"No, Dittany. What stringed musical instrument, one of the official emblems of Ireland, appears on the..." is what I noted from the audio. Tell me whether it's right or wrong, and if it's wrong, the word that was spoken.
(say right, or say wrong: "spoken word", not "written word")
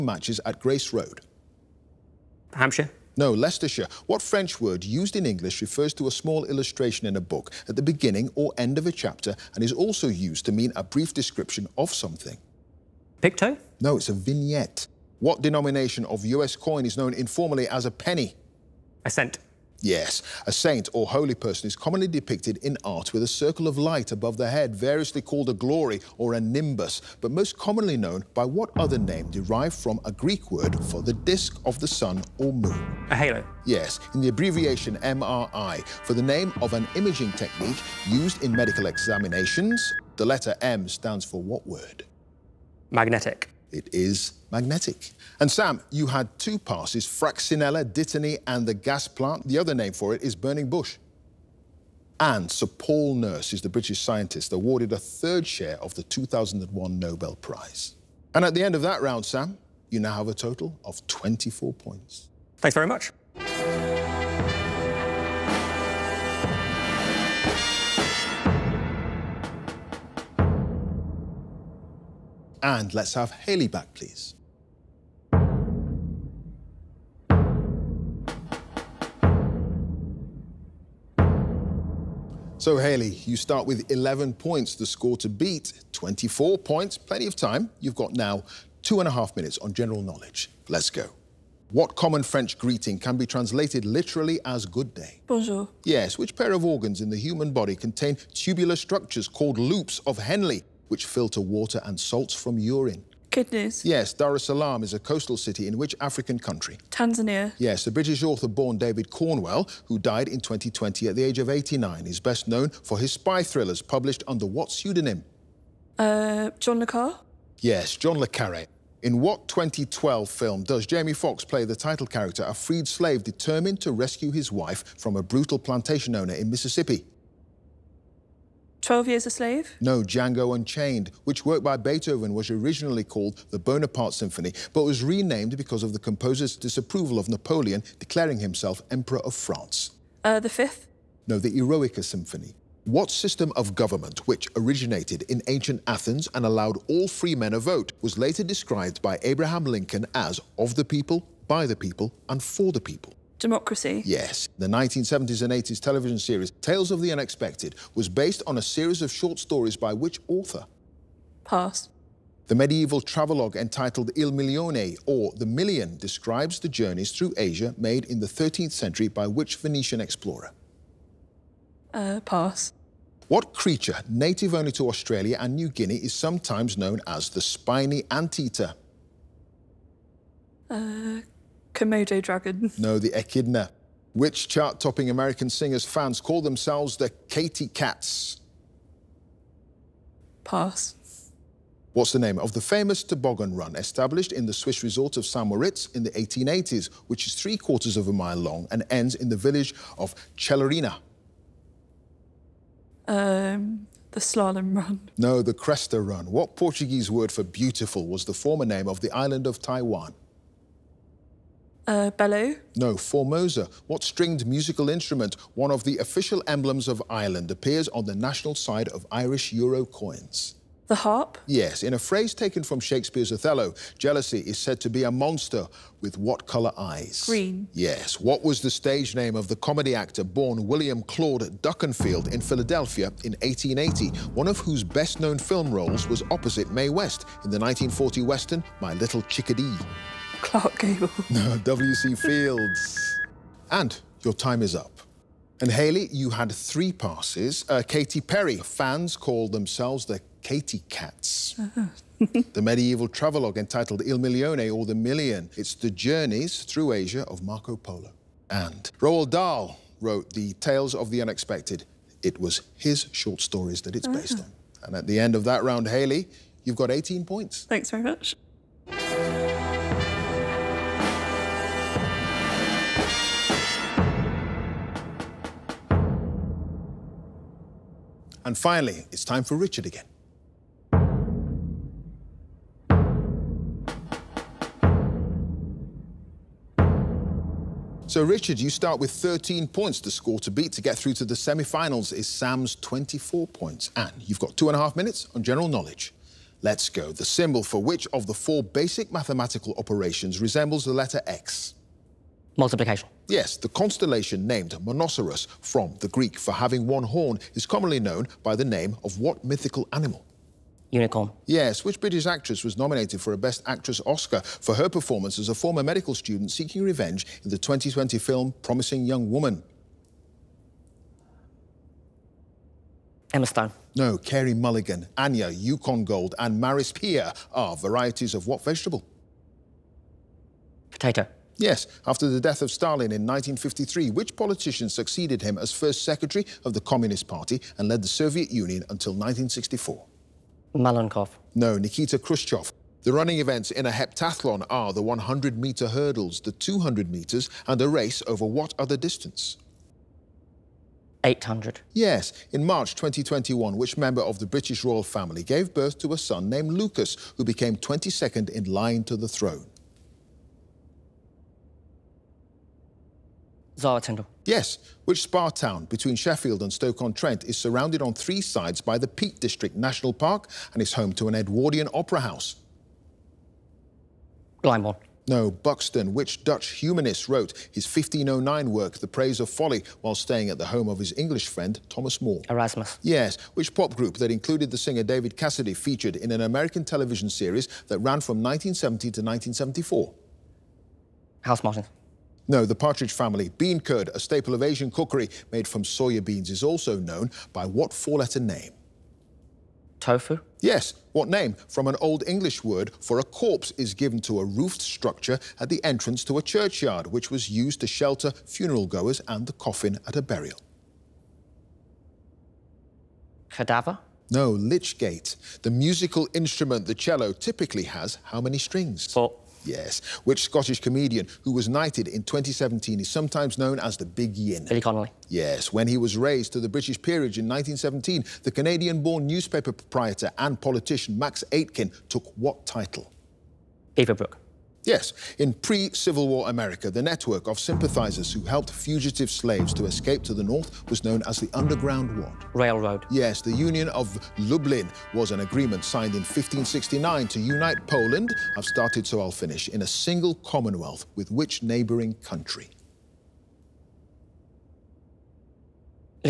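wrong: "Formosa", not "Dittany".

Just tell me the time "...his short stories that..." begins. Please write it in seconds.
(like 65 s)
262 s.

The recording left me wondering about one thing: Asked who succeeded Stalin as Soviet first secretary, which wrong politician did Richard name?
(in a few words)
Malenkov.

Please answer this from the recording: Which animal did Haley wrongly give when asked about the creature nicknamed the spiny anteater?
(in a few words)
Komodo dragon.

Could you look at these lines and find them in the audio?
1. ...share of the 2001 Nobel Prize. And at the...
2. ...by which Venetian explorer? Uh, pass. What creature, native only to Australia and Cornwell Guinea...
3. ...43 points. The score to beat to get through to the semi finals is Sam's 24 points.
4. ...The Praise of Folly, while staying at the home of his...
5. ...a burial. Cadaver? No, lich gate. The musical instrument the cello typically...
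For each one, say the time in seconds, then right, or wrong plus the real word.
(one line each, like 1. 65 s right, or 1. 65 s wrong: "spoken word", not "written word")
1. 55 s right
2. 169 s wrong: "New", not "Cornwell"
3. 289 s wrong: "13", not "43"
4. 378 s right
5. 410 s right.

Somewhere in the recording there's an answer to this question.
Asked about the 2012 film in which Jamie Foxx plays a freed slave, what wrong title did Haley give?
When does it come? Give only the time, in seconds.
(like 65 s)
128 s.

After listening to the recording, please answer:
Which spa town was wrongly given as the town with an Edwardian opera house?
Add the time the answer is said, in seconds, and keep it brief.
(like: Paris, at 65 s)
Glyndebourne, at 374 s.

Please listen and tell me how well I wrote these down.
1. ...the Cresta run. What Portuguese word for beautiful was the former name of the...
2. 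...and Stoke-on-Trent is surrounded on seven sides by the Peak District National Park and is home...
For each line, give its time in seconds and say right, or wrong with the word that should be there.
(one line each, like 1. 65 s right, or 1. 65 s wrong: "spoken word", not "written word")
1. 205 s right
2. 366 s wrong: "three", not "seven".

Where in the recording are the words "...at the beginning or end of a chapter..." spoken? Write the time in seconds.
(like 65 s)
7 s.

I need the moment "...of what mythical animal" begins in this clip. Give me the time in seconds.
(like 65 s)
309 s.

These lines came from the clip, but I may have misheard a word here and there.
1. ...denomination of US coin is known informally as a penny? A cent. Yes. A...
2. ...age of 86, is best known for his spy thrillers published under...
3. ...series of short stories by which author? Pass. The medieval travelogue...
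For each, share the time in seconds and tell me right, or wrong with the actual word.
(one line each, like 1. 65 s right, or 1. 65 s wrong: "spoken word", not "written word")
1. 15 s right
2. 111 s wrong: "89", not "86"
3. 158 s right.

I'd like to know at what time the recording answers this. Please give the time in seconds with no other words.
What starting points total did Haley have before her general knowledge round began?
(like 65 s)
83 s.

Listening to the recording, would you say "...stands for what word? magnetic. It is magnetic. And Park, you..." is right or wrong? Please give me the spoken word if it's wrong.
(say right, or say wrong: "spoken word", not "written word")
wrong: "Sam", not "Park".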